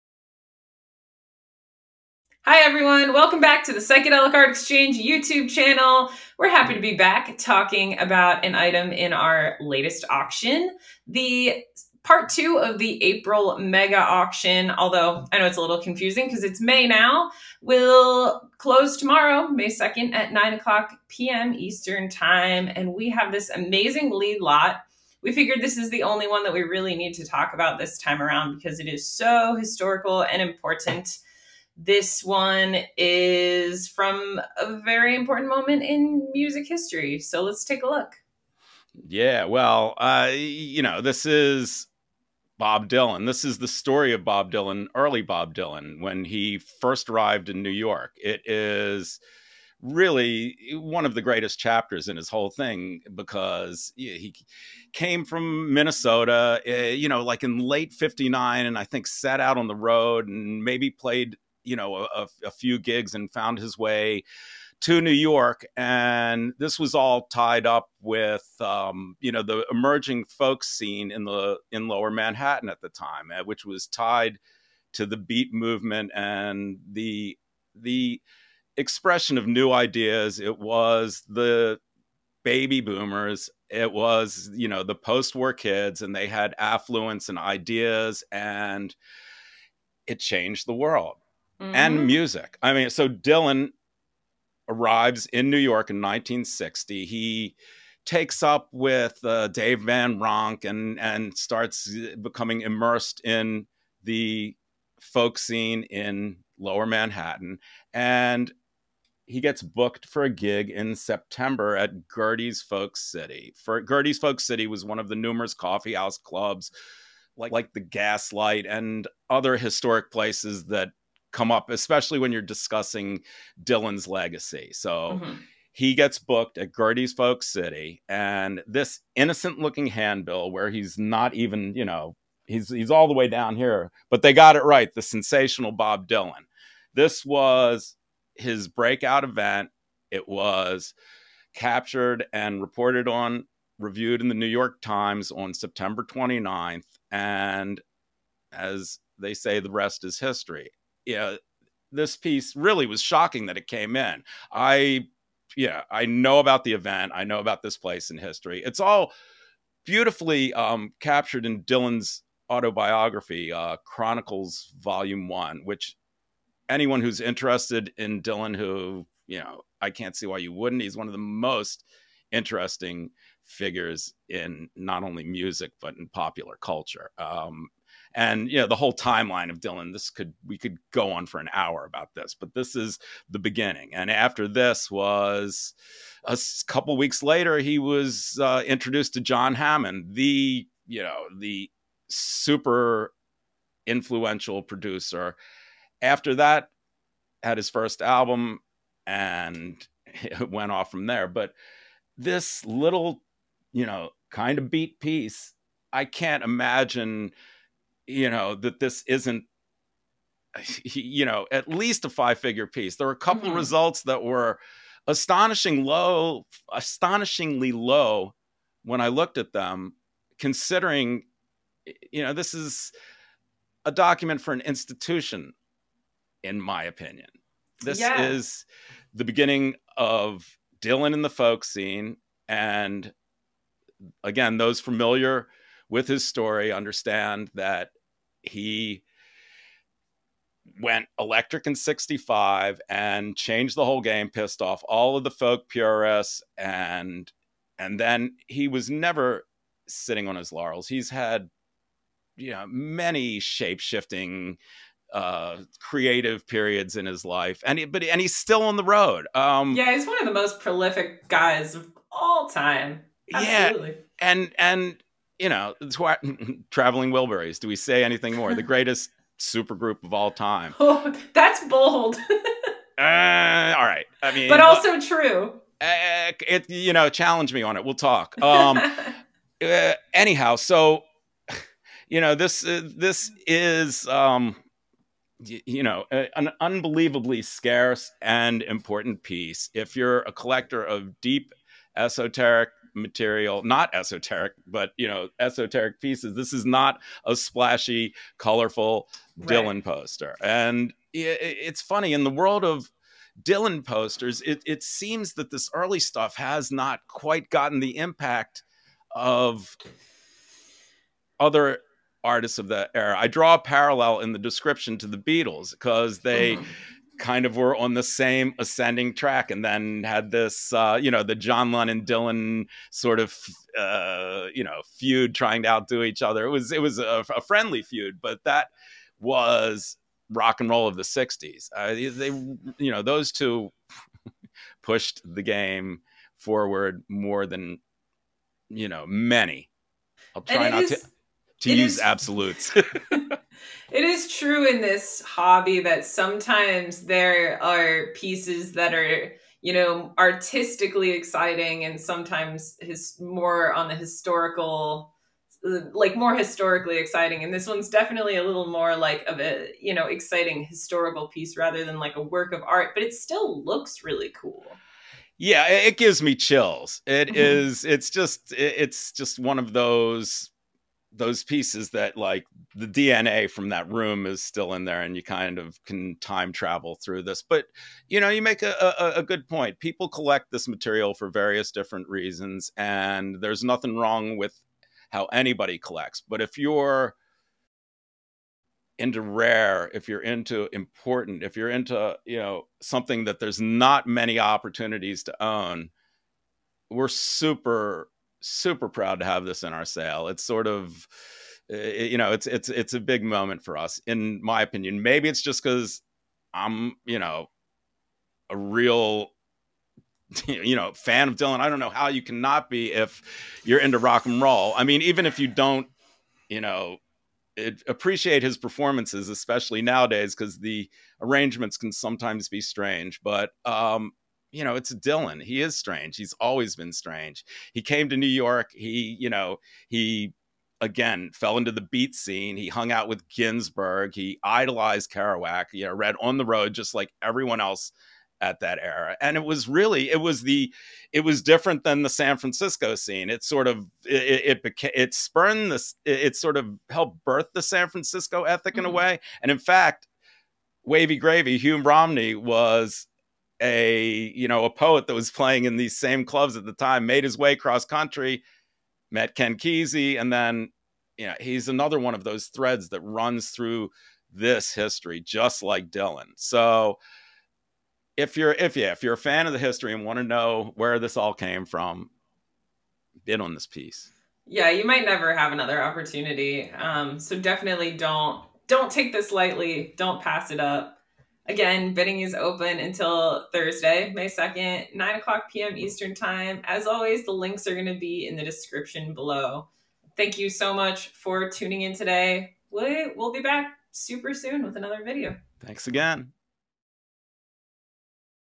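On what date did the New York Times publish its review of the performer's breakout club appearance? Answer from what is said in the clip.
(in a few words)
September 29th.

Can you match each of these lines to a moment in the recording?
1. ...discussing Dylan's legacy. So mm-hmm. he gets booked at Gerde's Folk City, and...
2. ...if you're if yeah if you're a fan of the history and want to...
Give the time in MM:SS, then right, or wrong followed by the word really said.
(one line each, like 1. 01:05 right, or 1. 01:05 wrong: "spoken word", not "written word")
1. 02:02 right
2. 07:48 right.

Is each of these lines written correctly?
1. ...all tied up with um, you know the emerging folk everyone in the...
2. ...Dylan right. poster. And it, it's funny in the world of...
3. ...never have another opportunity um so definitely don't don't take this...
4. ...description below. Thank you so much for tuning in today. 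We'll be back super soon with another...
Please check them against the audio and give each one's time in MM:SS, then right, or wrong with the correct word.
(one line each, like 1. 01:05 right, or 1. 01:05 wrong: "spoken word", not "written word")
1. 01:06 wrong: "scene", not "everyone"
2. 04:59 right
3. 07:55 right
4. 08:08 right.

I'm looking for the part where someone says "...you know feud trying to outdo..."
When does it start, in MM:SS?
05:24.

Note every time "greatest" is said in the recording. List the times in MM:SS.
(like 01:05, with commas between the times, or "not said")
00:51, 04:28.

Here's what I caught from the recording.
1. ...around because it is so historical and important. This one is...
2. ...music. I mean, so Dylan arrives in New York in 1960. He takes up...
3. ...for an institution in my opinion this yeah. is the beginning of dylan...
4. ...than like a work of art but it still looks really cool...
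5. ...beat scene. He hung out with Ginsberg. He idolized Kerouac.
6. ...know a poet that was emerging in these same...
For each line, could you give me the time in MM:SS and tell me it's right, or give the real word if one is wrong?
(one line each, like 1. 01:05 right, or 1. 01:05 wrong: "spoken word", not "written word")
1. 00:28 right
2. 01:32 right
3. 03:44 right
4. 06:01 right
5. 07:11 right
6. 07:34 wrong: "playing", not "emerging".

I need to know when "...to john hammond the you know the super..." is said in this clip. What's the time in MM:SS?
03:09.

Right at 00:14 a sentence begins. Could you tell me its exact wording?
Although I know it's a little confusing because it's May now, will close tomorrow, May 2nd at 9 o'clock p.m.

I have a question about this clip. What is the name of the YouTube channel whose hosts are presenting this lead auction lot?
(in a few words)
Psychedelic Art Exchange.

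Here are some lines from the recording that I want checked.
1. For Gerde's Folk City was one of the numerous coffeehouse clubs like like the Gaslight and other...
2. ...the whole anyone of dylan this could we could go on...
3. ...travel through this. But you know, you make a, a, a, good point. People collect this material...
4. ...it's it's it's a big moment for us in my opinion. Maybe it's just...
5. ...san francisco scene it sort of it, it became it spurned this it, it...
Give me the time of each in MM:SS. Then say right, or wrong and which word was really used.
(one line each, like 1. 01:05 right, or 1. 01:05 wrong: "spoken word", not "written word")
1. 01:53 right
2. 02:58 wrong: "timeline", not "anyone"
3. 06:16 right
4. 06:42 right
5. 07:22 right.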